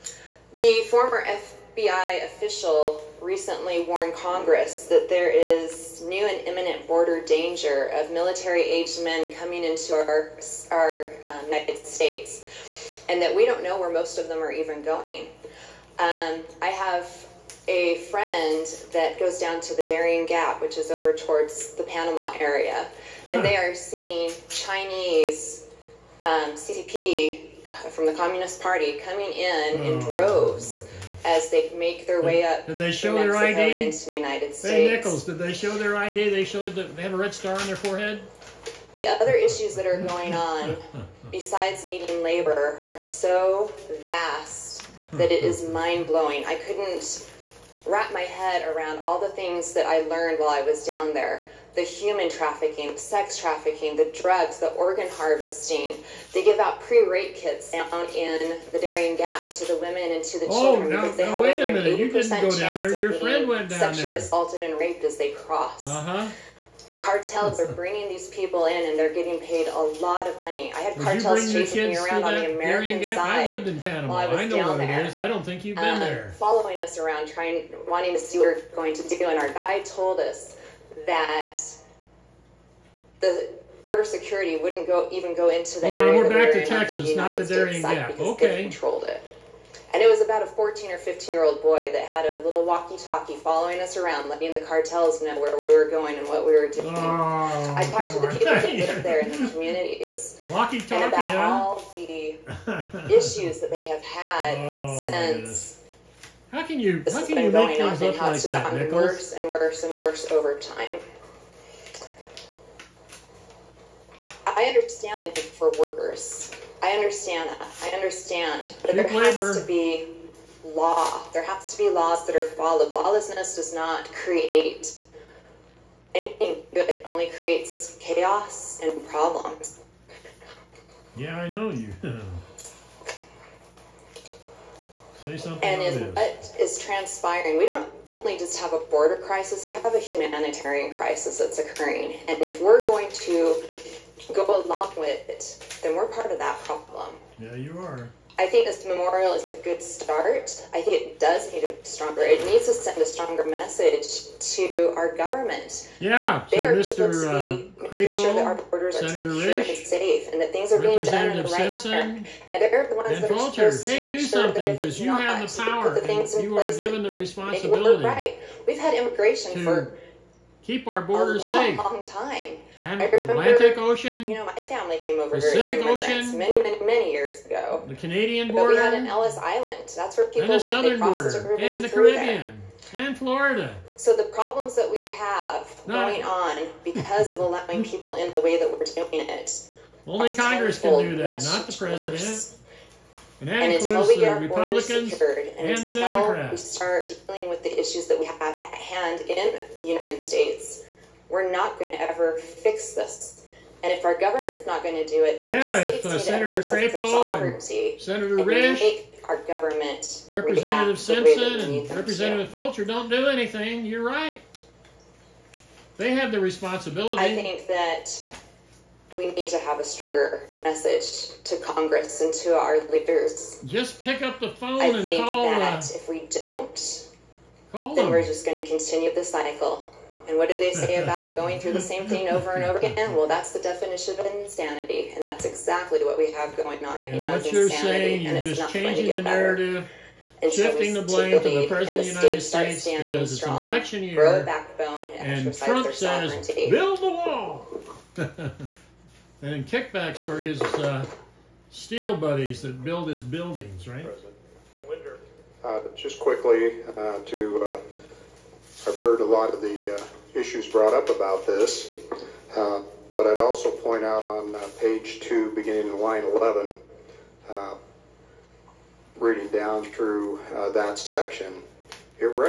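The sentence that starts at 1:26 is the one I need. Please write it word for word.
Now we're back to Texas, the not the Darien Gap.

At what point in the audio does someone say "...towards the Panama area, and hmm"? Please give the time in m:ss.
0:21.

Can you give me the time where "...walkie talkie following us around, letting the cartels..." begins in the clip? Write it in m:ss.
1:32.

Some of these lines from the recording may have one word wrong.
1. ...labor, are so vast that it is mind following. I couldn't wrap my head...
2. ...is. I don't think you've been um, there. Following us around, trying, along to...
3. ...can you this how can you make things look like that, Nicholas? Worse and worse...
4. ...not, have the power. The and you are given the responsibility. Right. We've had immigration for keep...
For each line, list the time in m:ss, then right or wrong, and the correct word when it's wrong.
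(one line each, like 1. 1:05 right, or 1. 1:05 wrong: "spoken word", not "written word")
1. 0:42 wrong: "blowing", not "following"
2. 1:15 wrong: "wanting", not "along"
3. 1:46 right
4. 2:45 right.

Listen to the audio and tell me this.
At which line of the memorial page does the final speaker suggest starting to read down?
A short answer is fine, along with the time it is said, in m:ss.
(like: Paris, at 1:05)
11, at 4:26.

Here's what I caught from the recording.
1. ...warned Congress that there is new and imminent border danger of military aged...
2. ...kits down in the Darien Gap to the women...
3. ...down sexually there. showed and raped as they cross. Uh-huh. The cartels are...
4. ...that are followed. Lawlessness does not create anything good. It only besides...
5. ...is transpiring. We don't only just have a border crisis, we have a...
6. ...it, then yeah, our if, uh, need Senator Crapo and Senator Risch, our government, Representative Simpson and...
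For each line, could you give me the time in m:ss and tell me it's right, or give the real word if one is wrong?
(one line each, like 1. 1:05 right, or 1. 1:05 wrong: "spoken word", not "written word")
1. 0:03 right
2. 0:57 right
3. 1:03 wrong: "assaulted", not "showed"
4. 2:02 wrong: "creates", not "besides"
5. 2:16 right
6. 3:25 right.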